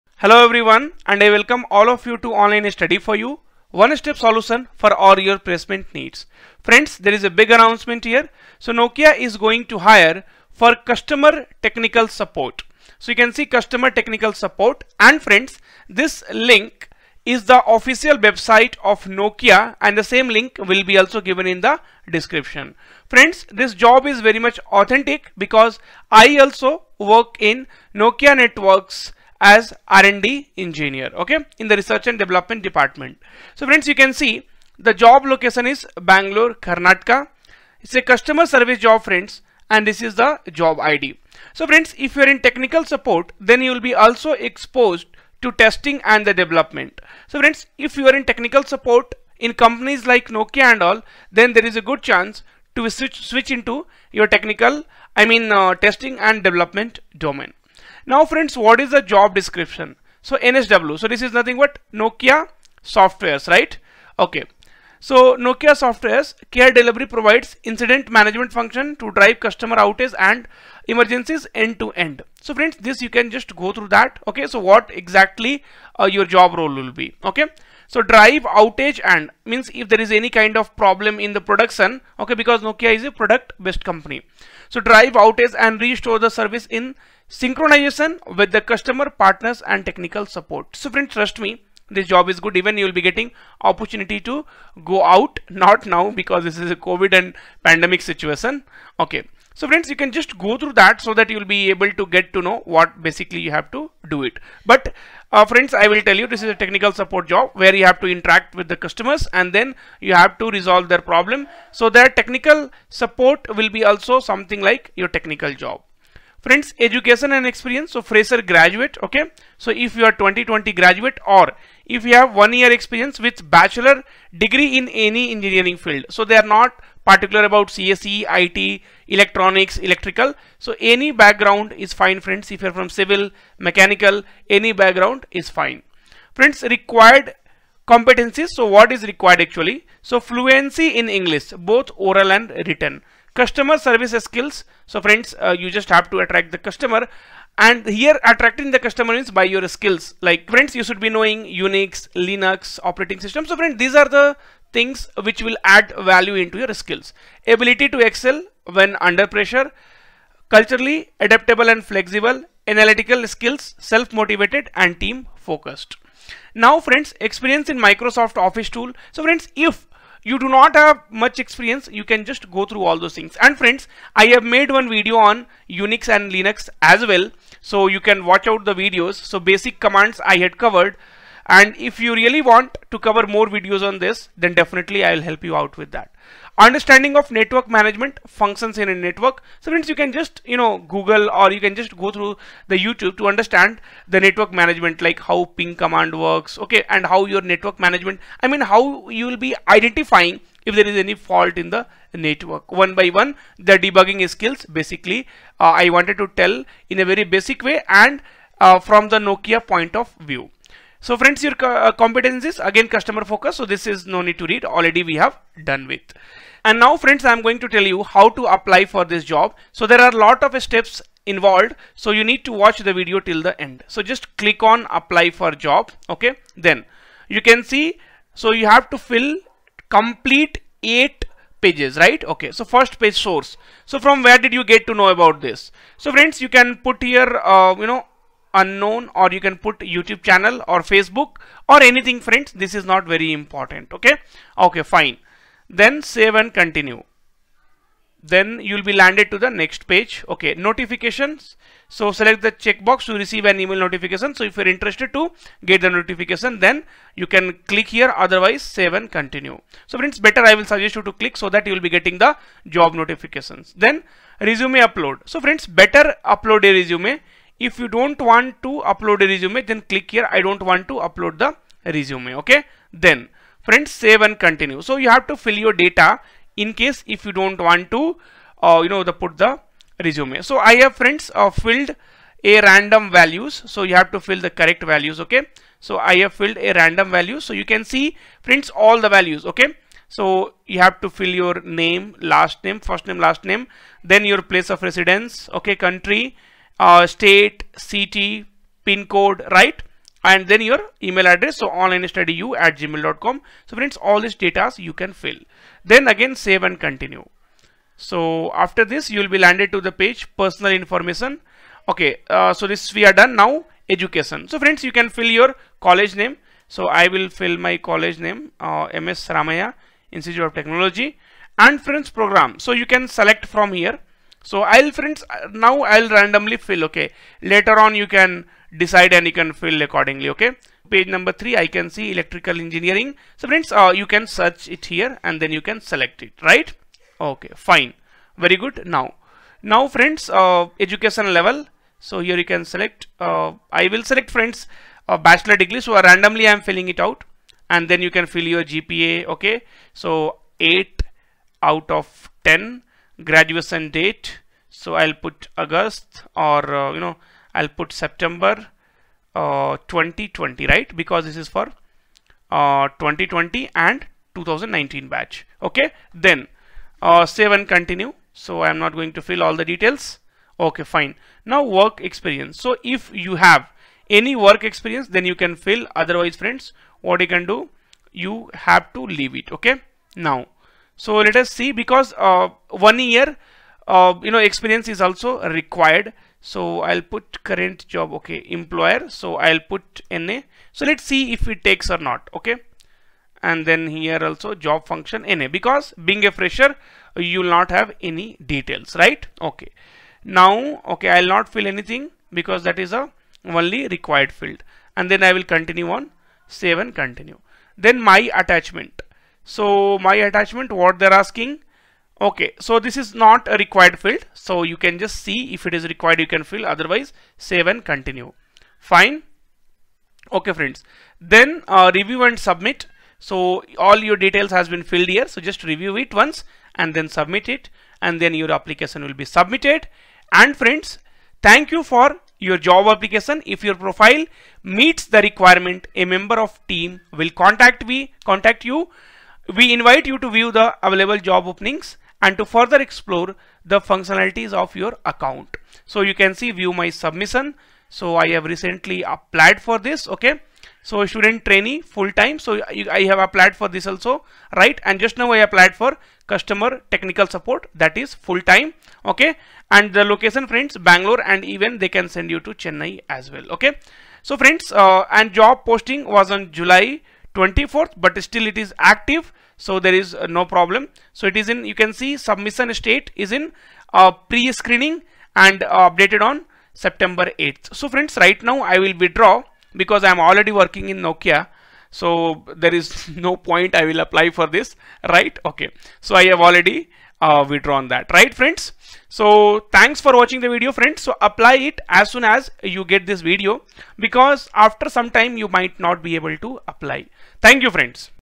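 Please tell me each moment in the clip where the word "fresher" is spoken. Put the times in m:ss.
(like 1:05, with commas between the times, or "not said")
1:58, 6:36.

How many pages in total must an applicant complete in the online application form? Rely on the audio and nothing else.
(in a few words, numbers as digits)
8.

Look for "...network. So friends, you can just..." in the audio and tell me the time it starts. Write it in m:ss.
3:08.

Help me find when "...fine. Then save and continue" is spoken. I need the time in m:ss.
4:04.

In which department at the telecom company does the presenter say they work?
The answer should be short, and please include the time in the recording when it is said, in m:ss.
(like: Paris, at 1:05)
Research and development, at 0:31.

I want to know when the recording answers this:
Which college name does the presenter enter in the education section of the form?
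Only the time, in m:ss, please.
5:18.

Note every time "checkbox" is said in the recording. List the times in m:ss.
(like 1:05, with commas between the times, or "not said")
4:12.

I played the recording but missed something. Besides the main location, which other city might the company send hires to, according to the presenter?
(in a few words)
Chennai.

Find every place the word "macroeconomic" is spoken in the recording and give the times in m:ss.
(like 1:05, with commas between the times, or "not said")
not said.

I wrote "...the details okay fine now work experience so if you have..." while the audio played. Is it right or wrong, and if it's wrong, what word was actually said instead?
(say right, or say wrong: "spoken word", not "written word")
right.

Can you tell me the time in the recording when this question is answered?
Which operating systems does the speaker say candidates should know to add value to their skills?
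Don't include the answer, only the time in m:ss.
2:31.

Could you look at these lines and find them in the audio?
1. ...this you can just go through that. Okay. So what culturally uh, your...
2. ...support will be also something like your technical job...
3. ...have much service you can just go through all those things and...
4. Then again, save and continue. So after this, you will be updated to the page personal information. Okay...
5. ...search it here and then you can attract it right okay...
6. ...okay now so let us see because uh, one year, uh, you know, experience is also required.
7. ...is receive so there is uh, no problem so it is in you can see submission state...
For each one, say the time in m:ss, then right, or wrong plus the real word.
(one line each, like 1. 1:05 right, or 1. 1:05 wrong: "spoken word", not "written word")
1. 1:12 wrong: "exactly", not "culturally"
2. 1:52 right
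3. 2:50 wrong: "experience", not "service"
4. 5:05 wrong: "landed", not "updated"
5. 5:34 wrong: "select", not "attract"
6. 6:19 right
7. 7:48 wrong: "active", not "receive".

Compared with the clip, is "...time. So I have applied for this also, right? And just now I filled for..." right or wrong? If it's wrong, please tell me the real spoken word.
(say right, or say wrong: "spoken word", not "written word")
wrong: "applied", not "filled".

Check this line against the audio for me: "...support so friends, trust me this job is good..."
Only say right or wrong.
right.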